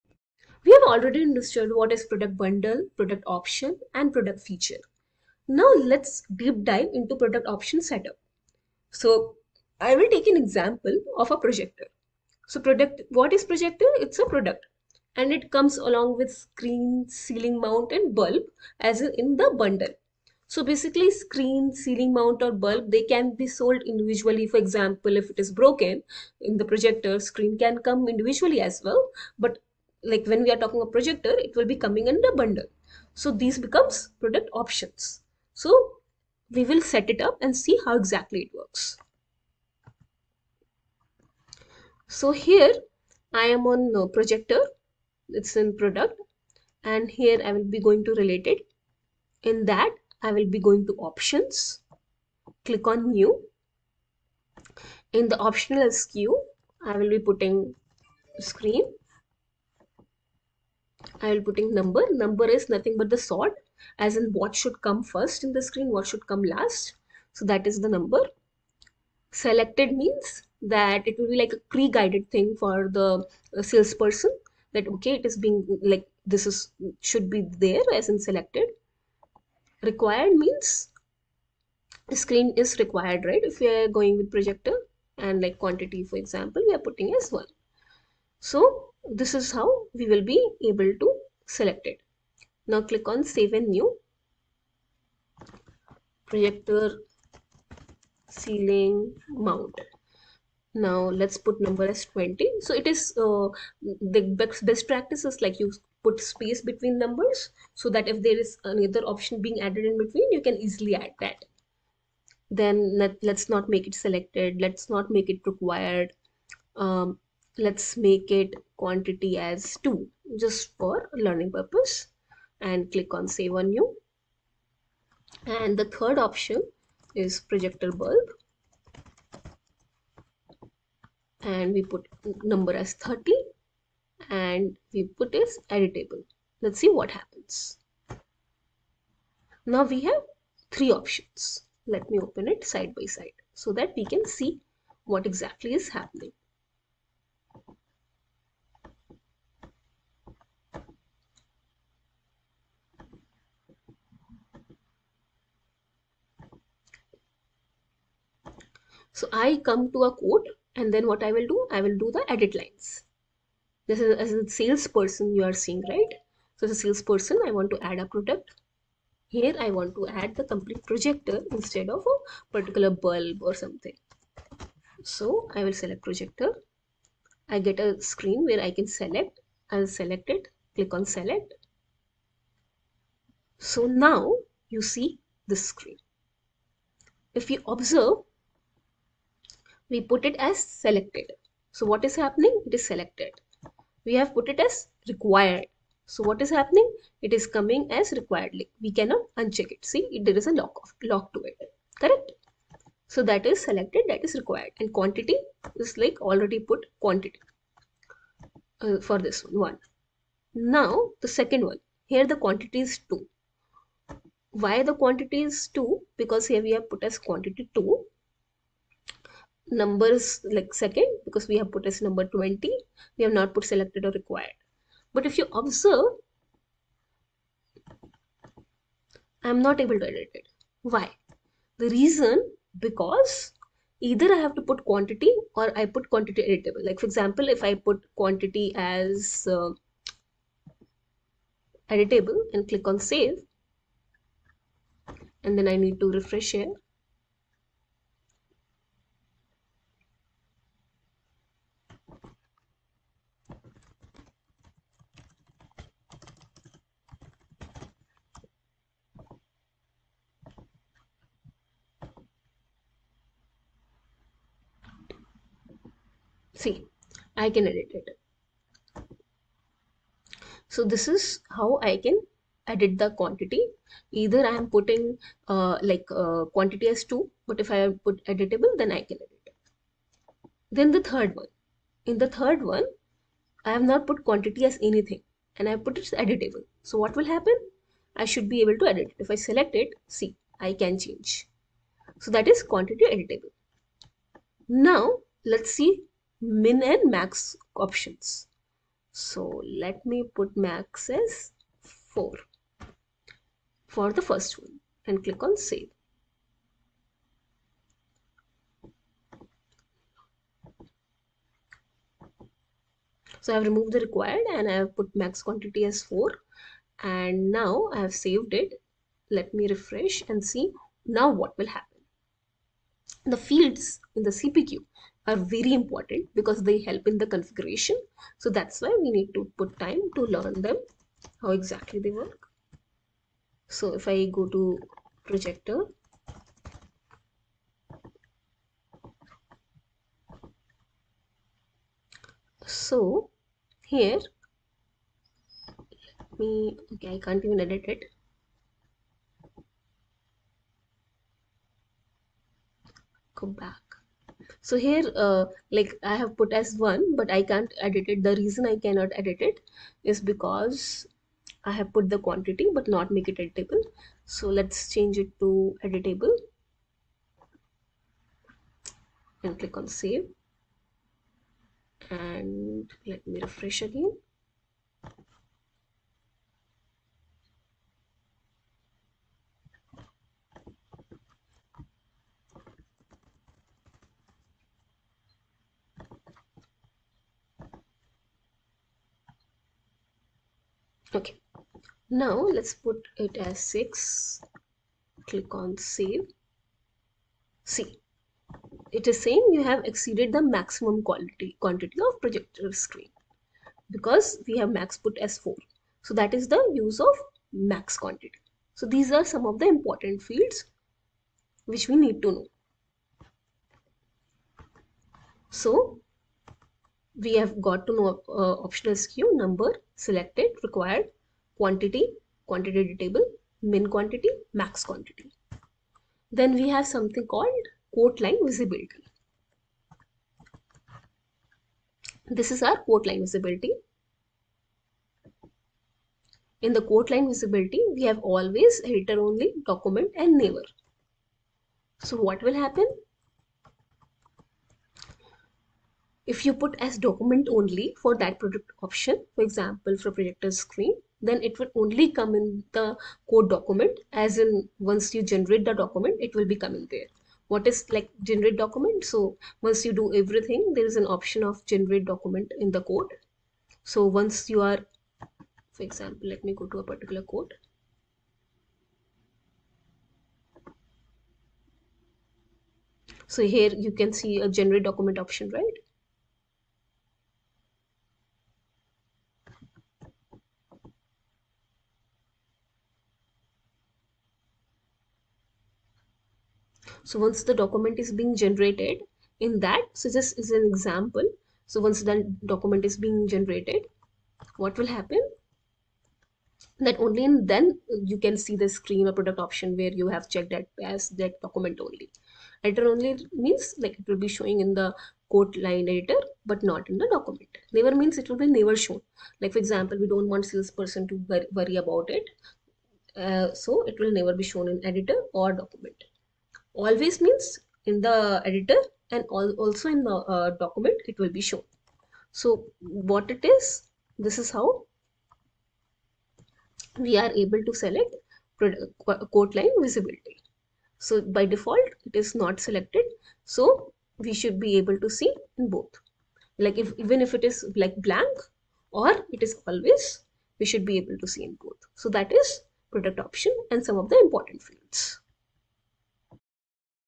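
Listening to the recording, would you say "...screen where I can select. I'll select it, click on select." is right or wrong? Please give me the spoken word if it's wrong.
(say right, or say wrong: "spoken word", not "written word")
right.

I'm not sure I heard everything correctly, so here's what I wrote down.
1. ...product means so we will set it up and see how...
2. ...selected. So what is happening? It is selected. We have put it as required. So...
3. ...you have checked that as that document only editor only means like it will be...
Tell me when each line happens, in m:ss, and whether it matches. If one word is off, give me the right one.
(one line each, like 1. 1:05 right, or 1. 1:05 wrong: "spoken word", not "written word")
1. 0:34 wrong: "options", not "means"
2. 3:10 right
3. 8:19 right.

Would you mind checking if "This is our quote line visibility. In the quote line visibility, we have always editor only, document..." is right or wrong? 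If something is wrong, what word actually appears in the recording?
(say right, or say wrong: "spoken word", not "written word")
right.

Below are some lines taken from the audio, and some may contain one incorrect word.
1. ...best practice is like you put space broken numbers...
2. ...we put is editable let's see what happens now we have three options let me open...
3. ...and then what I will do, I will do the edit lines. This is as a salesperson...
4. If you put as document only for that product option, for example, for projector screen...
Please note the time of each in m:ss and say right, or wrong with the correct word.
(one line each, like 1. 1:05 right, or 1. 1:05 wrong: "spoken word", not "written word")
1. 1:44 wrong: "between", not "broken"
2. 2:14 right
3. 2:40 right
4. 7:26 right.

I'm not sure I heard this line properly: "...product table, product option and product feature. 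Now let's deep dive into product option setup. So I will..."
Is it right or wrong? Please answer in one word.
wrong.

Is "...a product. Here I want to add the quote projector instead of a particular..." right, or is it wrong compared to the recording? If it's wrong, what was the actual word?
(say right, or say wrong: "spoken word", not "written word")
wrong: "complete", not "quote".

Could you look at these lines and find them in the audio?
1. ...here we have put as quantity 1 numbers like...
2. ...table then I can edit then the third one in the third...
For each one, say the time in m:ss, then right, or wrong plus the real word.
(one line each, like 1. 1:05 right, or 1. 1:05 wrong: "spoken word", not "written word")
1. 3:36 wrong: "2", not "1"
2. 4:38 wrong: "editable", not "table".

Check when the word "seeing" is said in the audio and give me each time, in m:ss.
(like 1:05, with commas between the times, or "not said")
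2:45.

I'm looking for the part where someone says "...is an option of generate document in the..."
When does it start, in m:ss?
7:40.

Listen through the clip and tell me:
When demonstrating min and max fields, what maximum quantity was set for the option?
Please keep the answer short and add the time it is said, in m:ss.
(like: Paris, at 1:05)
4, at 5:00.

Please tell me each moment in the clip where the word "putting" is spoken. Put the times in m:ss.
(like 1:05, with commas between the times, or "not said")
0:57, 1:01, 1:26, 4:34.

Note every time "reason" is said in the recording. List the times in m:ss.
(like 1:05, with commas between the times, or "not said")
3:51, 5:58.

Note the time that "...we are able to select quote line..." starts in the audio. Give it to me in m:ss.
8:46.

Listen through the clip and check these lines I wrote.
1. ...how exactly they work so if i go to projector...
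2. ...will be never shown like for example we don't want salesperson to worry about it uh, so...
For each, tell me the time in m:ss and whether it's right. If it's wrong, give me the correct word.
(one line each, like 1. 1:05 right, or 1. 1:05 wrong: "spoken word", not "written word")
1. 5:31 right
2. 8:28 right.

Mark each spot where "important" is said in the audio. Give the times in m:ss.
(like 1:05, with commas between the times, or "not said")
5:25, 6:49, 9:04.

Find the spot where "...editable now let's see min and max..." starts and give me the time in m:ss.
4:53.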